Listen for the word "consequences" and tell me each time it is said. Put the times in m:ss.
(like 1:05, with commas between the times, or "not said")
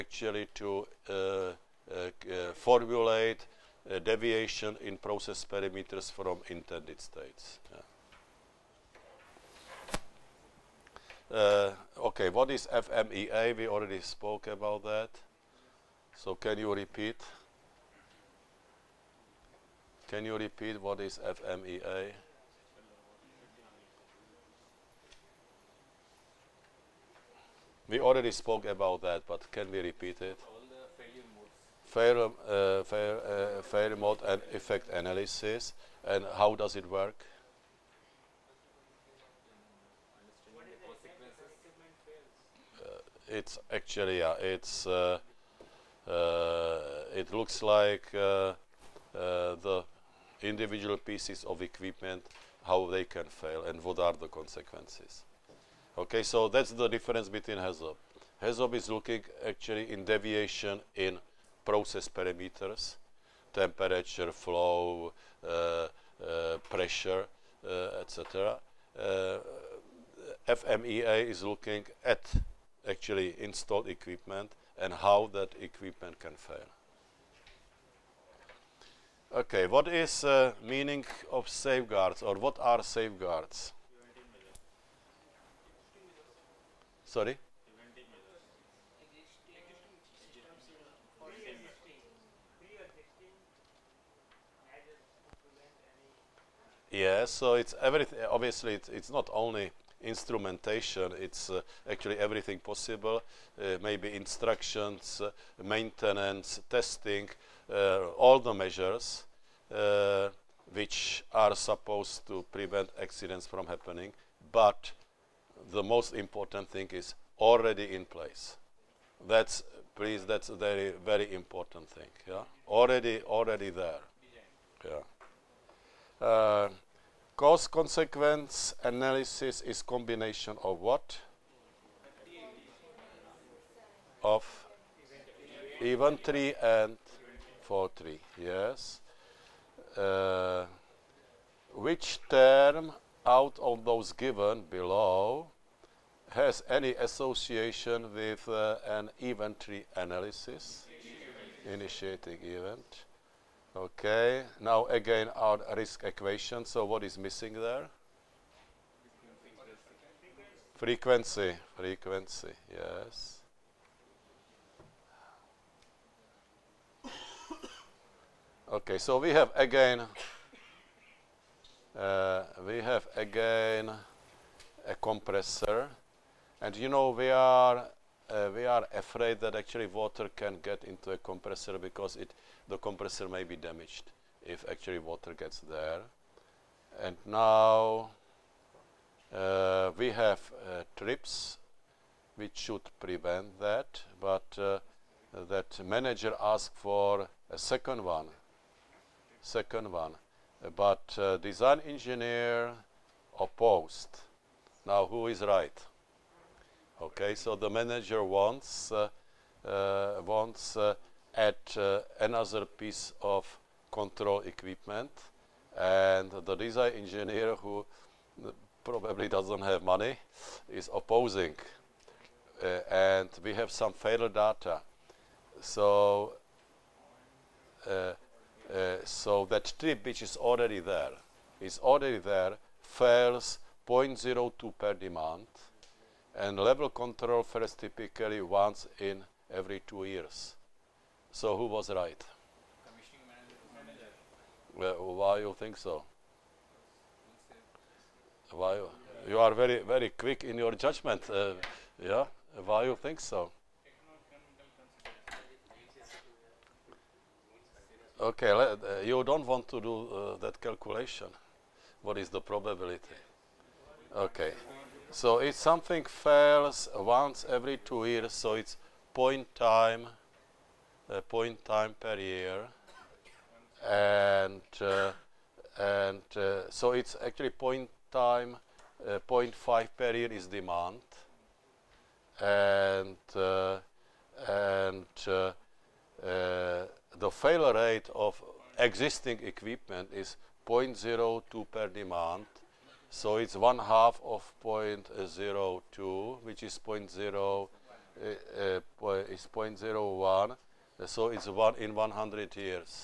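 0:54, 2:07.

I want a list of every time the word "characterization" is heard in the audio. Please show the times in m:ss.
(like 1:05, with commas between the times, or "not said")
not said.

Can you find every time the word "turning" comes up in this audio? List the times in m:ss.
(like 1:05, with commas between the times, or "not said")
not said.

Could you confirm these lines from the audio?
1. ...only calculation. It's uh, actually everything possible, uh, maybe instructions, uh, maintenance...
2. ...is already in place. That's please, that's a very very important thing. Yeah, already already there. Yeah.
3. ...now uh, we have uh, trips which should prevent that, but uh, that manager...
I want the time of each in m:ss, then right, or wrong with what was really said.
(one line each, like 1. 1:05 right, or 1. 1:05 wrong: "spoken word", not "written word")
1. 1:39 wrong: "instrumentation", not "calculation"
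2. 1:56 right
3. 3:07 right.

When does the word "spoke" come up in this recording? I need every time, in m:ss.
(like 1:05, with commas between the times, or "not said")
0:13, 0:28.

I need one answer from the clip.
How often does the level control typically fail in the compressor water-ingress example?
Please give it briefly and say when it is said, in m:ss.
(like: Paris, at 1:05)
Once every two years, at 3:58.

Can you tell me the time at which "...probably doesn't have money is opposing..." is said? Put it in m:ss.
3:38.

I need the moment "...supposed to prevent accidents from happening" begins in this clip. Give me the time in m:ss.
1:51.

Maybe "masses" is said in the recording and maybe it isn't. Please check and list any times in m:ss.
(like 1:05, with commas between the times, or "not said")
not said.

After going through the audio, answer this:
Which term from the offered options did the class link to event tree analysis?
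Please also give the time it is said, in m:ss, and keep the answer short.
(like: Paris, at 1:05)
Initiating event, at 2:31.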